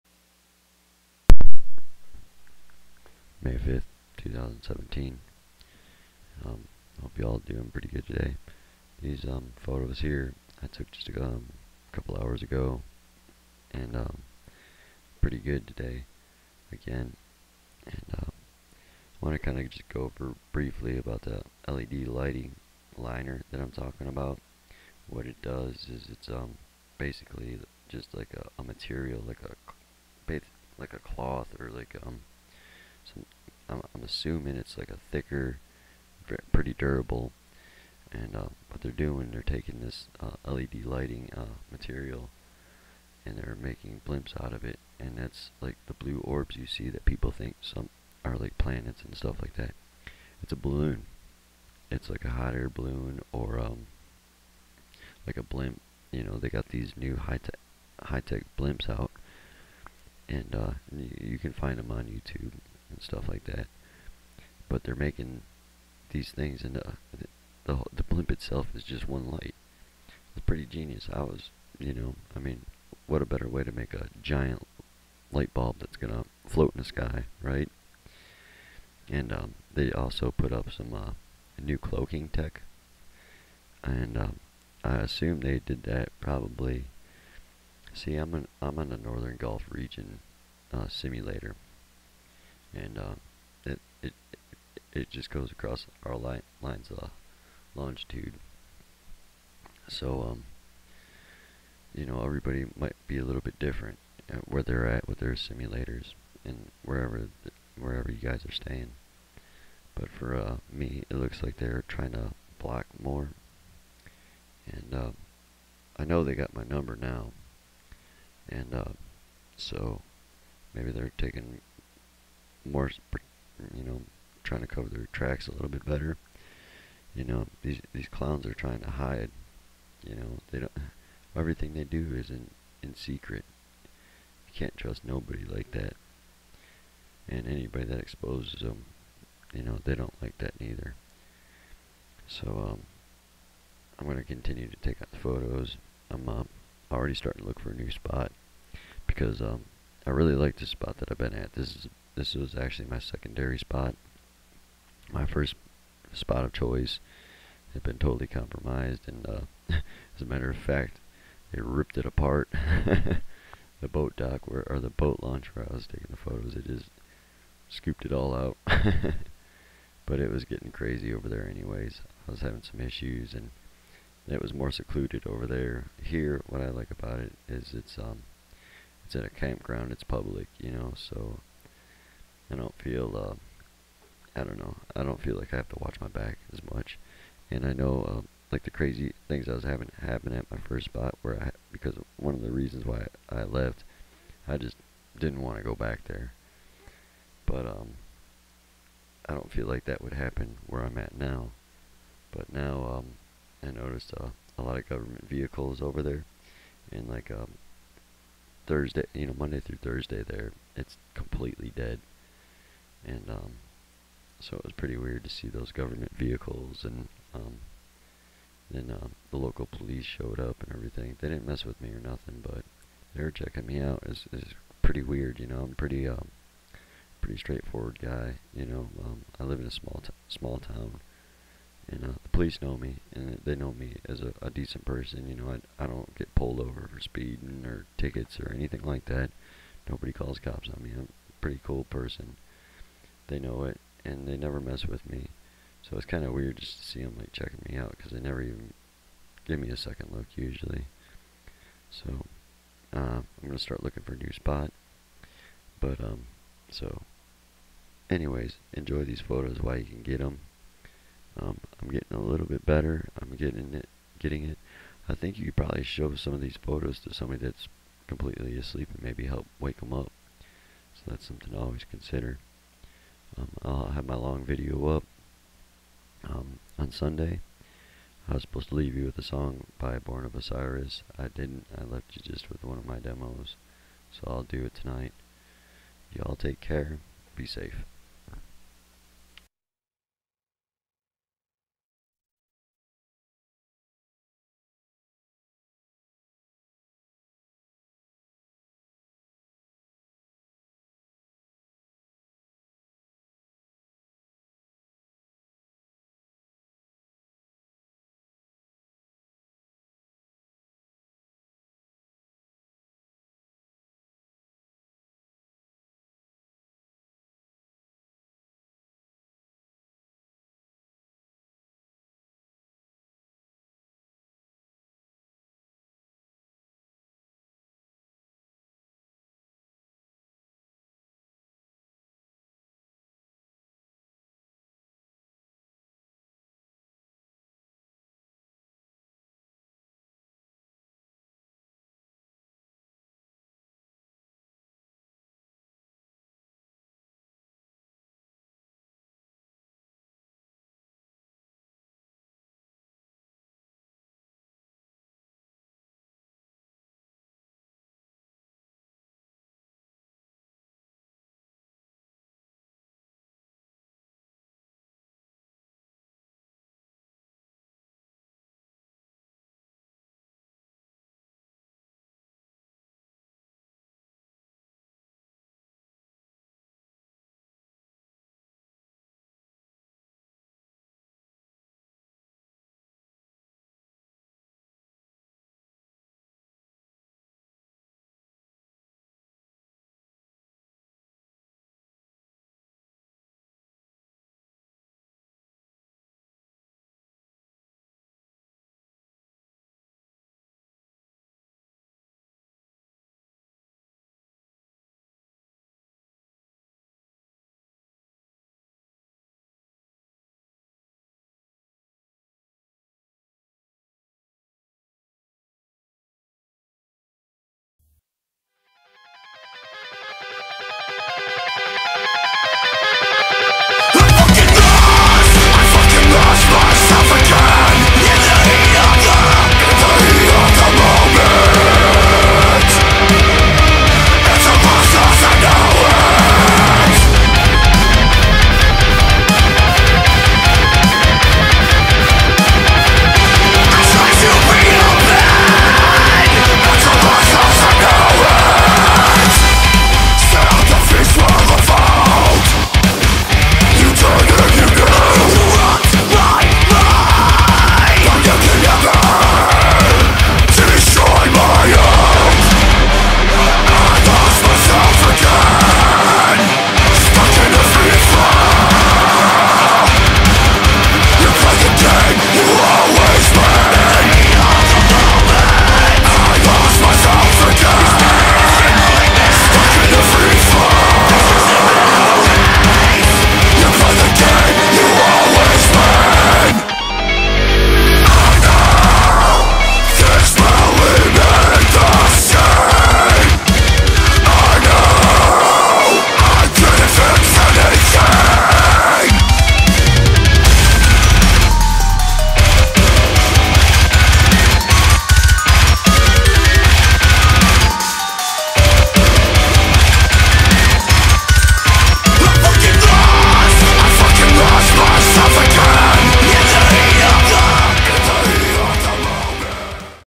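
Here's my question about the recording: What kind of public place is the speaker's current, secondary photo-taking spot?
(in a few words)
A campground.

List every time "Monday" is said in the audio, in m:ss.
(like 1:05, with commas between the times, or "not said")
3:29.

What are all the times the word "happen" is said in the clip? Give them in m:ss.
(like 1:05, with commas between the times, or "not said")
3:10, 3:20.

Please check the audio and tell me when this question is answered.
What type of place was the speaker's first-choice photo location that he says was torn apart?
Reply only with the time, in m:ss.
2:44.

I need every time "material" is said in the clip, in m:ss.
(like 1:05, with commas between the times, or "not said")
0:28, 0:41.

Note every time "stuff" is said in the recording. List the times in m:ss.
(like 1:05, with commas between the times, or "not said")
0:49, 1:03.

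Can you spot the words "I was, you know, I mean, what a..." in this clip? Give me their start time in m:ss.
1:11.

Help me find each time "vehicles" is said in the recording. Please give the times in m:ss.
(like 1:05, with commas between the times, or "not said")
3:25, 3:36.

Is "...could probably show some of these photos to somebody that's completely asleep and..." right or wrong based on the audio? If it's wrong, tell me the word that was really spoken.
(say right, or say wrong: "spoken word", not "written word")
right.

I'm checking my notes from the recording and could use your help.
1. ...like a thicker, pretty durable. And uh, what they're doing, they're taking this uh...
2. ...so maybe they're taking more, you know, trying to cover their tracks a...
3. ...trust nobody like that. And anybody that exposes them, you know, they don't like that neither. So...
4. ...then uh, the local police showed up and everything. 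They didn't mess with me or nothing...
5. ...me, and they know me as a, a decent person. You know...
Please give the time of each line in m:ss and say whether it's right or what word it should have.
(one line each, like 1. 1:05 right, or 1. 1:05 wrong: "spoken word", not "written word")
1. 0:34 right
2. 1:59 right
3. 2:14 right
4. 3:38 right
5. 3:52 right.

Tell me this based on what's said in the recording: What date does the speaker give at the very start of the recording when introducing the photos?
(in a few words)
May 5th, 2017.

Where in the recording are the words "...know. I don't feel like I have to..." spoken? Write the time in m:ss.
3:04.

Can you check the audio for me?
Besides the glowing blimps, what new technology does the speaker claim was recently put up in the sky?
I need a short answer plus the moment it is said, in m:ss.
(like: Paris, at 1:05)
Cloaking tech, at 1:21.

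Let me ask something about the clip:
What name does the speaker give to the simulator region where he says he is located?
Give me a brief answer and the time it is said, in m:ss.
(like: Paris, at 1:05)
Northern Gulf region, at 1:28.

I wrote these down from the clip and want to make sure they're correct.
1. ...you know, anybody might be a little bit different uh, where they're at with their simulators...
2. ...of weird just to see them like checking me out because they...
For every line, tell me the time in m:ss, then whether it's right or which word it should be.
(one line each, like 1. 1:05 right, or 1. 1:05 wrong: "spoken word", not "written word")
1. 1:41 wrong: "everybody", not "anybody"
2. 4:06 right.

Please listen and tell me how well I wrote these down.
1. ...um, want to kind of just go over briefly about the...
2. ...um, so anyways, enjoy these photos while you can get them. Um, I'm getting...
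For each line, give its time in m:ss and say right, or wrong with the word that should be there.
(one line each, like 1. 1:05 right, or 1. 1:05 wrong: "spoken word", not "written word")
1. 0:18 right
2. 4:16 right.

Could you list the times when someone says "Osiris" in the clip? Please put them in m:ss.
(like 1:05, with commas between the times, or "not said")
4:40.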